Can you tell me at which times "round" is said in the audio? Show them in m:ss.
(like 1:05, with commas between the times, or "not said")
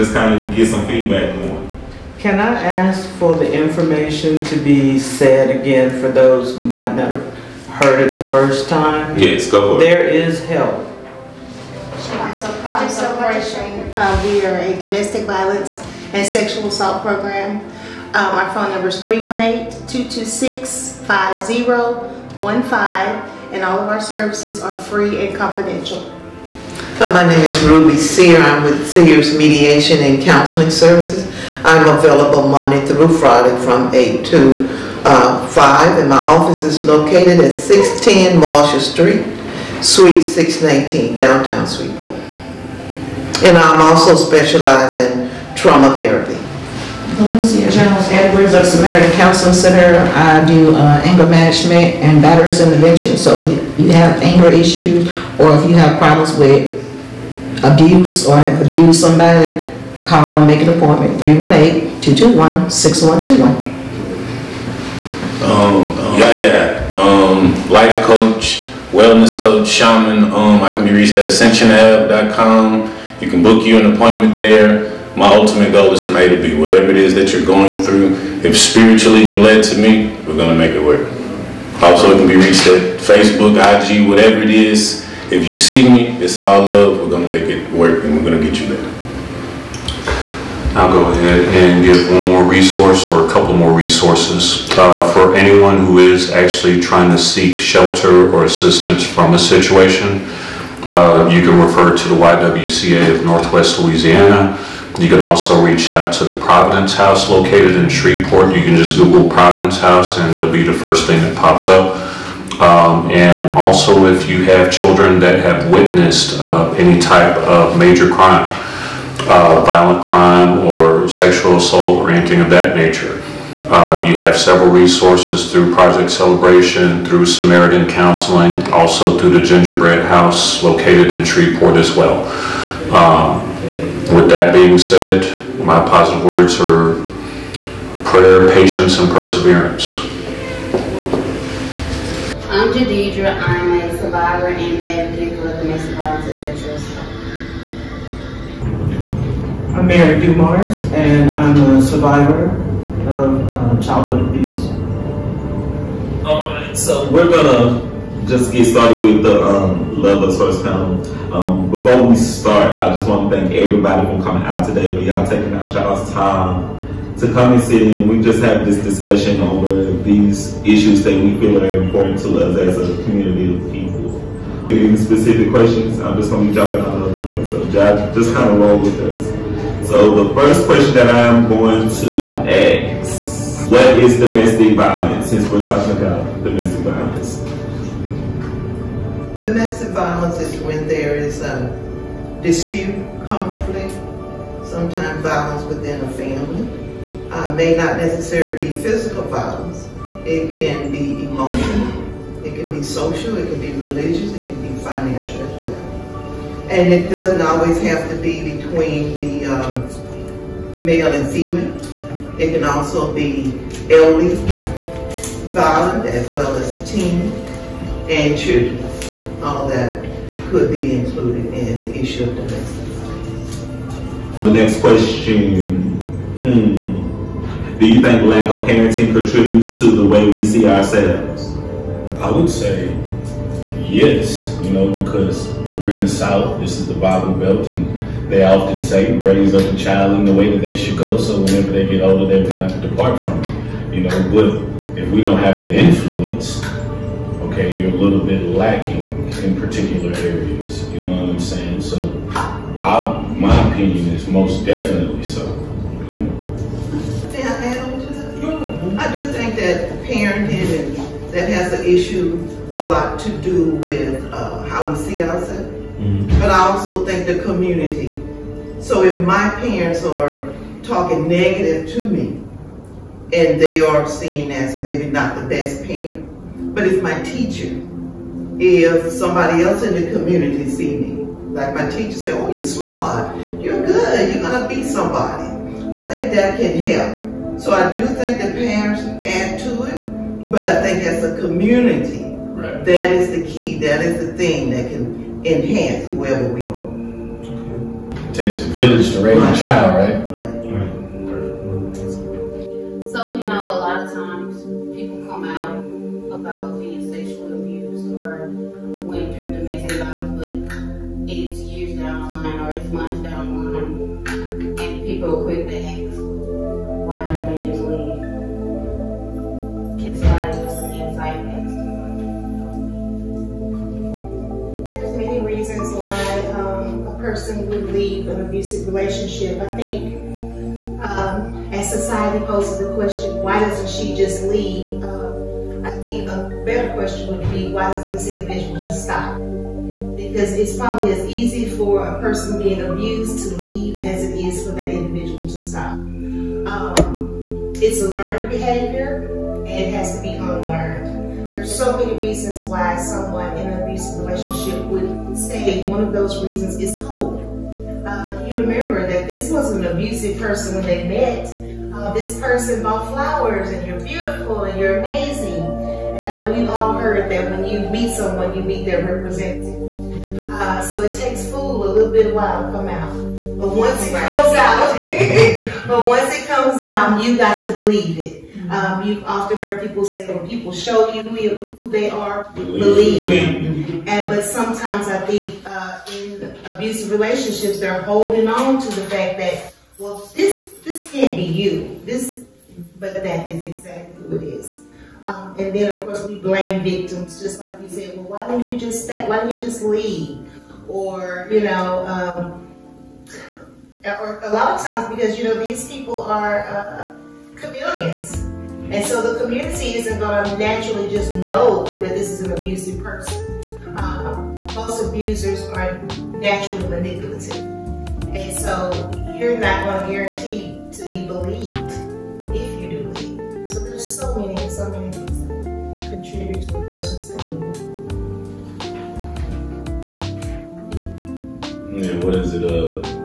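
not said.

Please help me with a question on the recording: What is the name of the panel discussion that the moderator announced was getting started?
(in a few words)
Love Us First.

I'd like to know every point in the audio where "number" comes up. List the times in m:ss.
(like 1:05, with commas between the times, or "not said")
0:18.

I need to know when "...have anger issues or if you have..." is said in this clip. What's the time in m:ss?
0:53.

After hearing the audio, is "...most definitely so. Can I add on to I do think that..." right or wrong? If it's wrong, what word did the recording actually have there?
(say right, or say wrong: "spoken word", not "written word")
right.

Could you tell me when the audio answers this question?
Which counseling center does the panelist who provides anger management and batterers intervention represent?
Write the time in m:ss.
0:48.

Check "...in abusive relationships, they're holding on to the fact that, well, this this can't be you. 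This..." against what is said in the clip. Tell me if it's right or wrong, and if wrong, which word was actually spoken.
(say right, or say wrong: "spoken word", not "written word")
right.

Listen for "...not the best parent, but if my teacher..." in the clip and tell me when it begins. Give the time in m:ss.
4:35.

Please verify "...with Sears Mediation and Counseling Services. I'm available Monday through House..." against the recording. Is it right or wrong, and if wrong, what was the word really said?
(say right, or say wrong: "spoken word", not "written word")
wrong: "Friday", not "House".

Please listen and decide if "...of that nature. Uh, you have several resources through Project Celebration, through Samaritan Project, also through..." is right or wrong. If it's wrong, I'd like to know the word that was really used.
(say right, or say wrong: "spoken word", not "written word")
wrong: "Counseling", not "Project".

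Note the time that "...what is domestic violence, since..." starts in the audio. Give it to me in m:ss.
3:03.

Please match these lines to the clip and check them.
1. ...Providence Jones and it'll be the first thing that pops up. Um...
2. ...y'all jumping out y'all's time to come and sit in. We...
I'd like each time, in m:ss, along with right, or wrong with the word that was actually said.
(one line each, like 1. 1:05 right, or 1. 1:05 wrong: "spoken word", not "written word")
1. 1:49 wrong: "House", not "Jones"
2. 2:45 wrong: "taking", not "jumping".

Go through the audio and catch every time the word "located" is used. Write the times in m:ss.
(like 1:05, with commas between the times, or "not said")
0:36, 1:47, 2:10.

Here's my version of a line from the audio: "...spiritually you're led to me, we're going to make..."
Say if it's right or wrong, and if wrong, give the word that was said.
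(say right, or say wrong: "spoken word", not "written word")
right.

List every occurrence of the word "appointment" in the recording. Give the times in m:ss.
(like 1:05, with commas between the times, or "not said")
1:00, 1:13.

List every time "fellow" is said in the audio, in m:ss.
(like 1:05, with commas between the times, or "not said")
not said.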